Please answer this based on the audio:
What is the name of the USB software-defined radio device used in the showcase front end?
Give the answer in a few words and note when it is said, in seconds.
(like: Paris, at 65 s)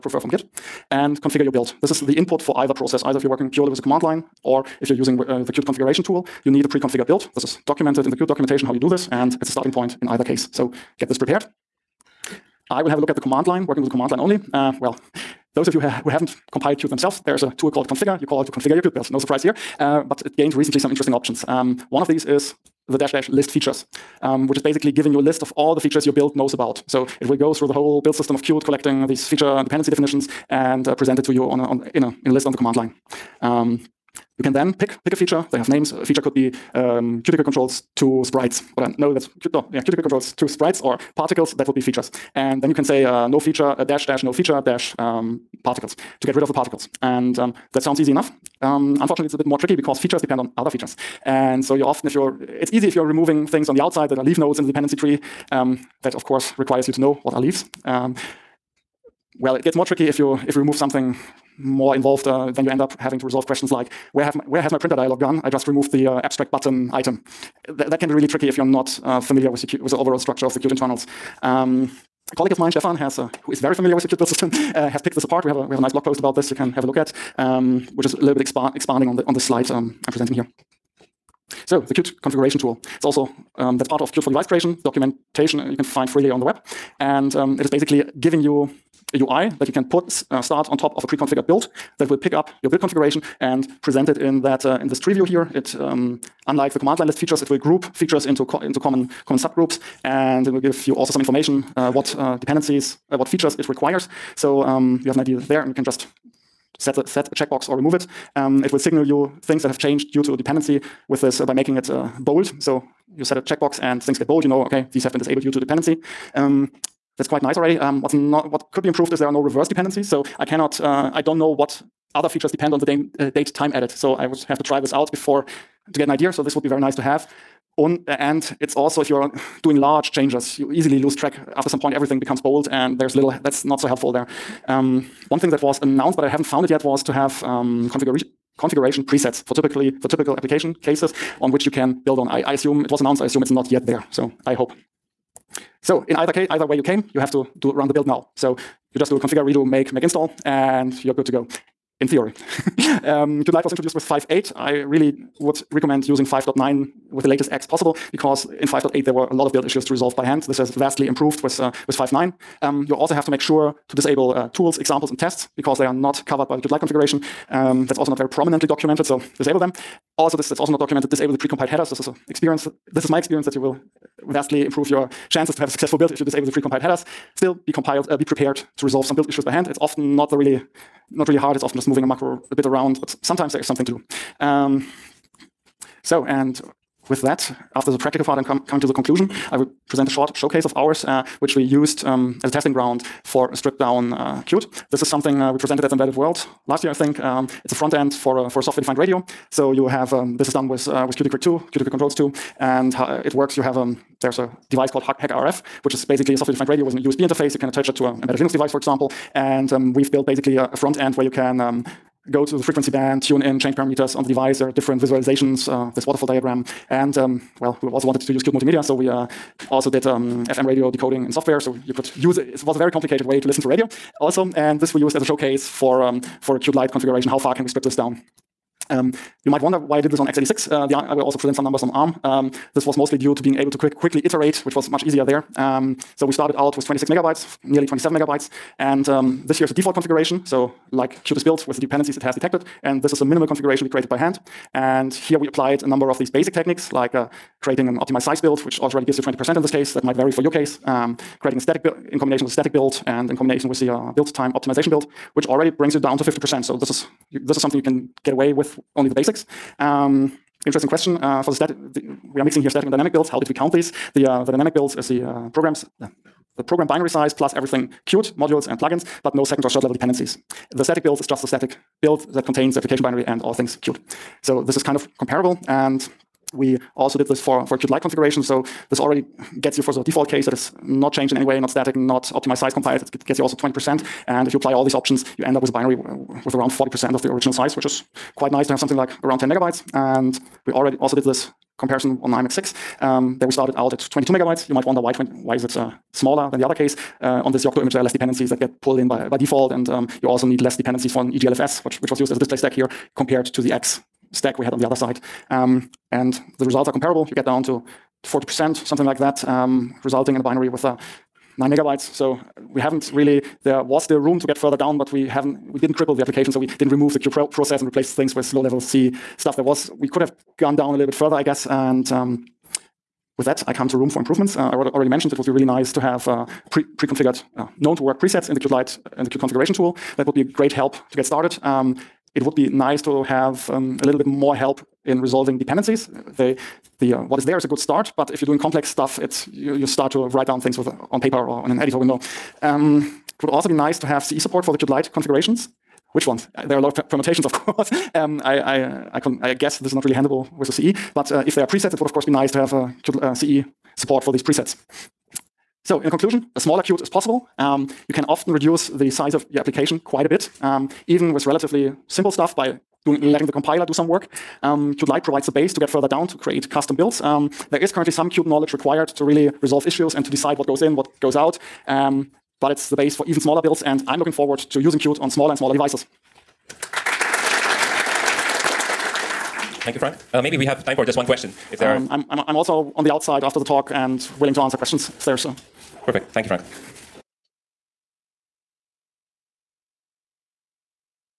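HackRF, at 205 s.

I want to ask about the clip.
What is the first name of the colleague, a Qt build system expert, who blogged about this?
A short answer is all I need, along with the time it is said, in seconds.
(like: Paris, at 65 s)
Stefan, at 72 s.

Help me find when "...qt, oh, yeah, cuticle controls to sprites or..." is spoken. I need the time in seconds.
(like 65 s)
39 s.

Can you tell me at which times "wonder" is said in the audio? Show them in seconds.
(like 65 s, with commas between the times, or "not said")
229 s, 294 s.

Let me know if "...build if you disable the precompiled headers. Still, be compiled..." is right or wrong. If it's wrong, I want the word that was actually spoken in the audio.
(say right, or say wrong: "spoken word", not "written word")
right.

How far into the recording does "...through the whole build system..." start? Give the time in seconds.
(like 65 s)
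27 s.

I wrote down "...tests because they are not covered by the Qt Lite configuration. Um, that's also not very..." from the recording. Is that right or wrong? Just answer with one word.
right.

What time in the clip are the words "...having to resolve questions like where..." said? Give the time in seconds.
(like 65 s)
63 s.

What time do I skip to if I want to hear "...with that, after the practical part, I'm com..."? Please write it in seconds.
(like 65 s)
187 s.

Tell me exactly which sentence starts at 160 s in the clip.
This has vastly improved with uh, with 5.9.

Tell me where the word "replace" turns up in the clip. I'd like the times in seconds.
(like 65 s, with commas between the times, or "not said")
317 s.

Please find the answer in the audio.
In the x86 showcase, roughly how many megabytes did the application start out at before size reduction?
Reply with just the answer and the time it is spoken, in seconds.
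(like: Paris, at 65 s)
nearly 27 megabytes, at 237 s.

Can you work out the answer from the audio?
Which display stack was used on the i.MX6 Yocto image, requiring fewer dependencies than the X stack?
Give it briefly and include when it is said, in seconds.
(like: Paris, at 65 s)
EGLFS, at 301 s.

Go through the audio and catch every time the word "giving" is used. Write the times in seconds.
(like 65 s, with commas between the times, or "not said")
24 s, 88 s.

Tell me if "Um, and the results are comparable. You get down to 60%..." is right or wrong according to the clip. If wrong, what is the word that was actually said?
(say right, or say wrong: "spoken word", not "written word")
wrong: "40", not "60".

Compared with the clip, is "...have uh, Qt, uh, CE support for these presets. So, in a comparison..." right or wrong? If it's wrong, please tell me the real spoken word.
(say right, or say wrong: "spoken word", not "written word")
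wrong: "conclusion", not "comparison".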